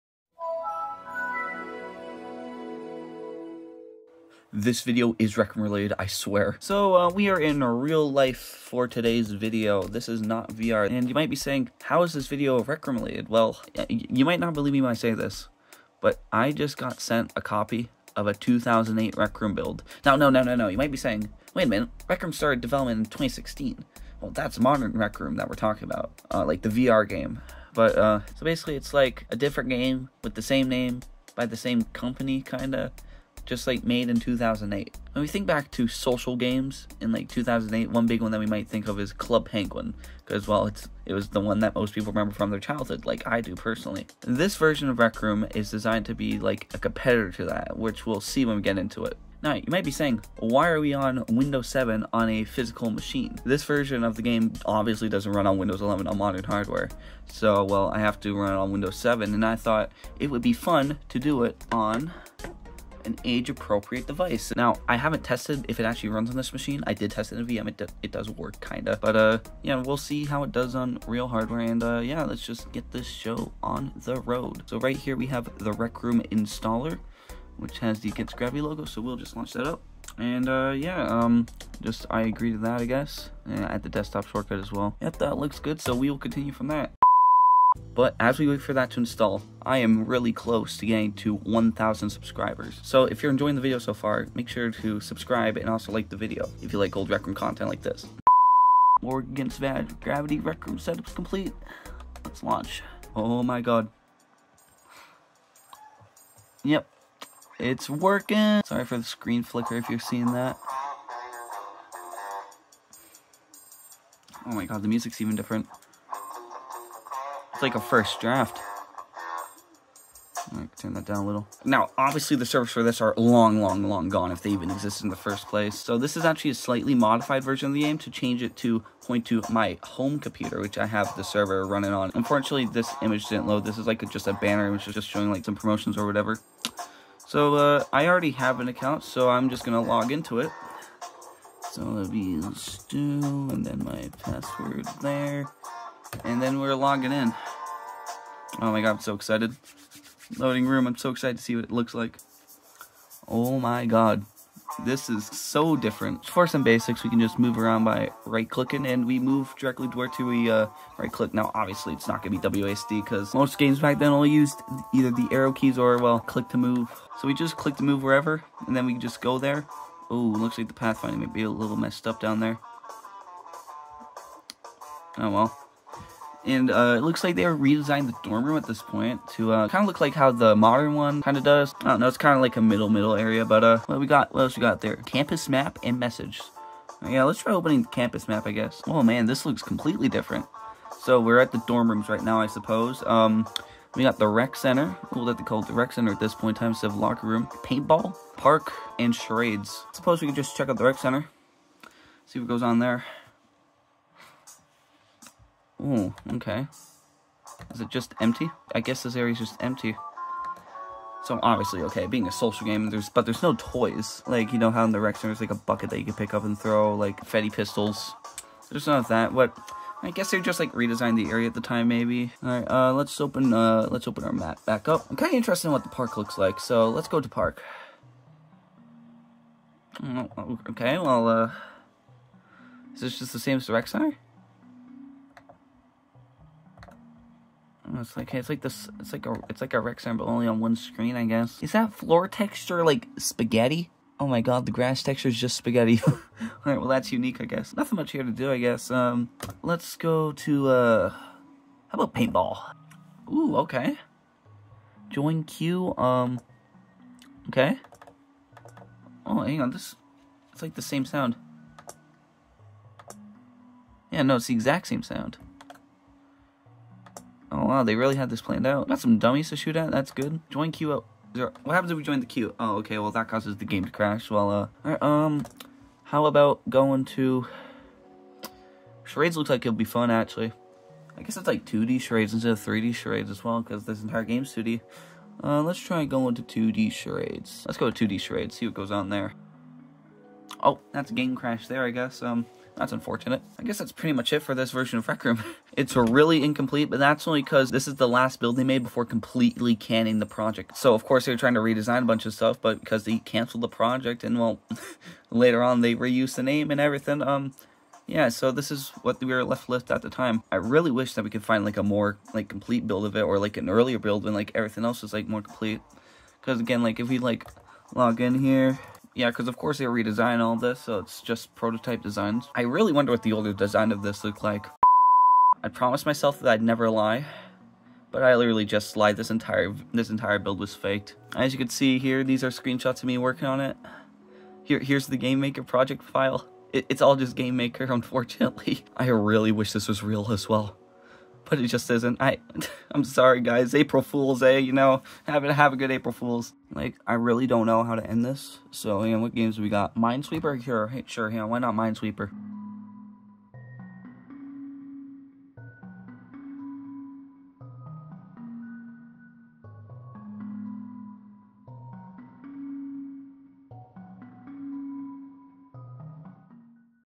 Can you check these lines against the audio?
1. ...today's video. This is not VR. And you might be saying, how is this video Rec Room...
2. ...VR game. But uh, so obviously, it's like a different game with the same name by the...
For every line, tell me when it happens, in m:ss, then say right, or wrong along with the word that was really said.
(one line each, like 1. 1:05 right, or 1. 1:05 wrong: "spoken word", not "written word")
1. 0:08 right
2. 0:26 wrong: "basically", not "obviously".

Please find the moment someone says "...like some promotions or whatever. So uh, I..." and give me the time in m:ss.
2:15.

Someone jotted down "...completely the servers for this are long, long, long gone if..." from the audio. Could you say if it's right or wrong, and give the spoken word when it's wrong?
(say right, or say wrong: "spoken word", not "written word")
wrong: "obviously", not "completely".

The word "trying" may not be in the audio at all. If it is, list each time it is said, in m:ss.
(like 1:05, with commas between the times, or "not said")
5:01.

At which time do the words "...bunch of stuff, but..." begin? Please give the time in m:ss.
5:02.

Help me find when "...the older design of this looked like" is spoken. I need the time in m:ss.
5:23.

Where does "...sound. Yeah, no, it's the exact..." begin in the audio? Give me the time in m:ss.
4:21.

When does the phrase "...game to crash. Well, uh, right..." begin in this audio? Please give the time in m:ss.
4:33.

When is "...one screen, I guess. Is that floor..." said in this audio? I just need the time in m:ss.
4:00.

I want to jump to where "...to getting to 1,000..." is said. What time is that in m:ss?
1:30.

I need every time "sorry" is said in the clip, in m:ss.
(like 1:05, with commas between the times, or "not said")
1:48, 5:43.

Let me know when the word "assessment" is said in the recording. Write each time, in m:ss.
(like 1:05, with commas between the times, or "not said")
not said.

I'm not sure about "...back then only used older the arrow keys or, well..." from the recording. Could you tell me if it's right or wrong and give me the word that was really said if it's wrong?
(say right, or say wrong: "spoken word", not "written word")
wrong: "either", not "older".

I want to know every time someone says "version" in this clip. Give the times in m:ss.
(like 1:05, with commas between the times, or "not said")
0:44, 0:53, 2:07, 4:54.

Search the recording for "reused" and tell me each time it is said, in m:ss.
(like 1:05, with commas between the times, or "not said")
5:05.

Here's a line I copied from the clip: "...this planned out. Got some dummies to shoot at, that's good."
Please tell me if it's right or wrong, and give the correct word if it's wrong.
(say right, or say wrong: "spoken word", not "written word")
right.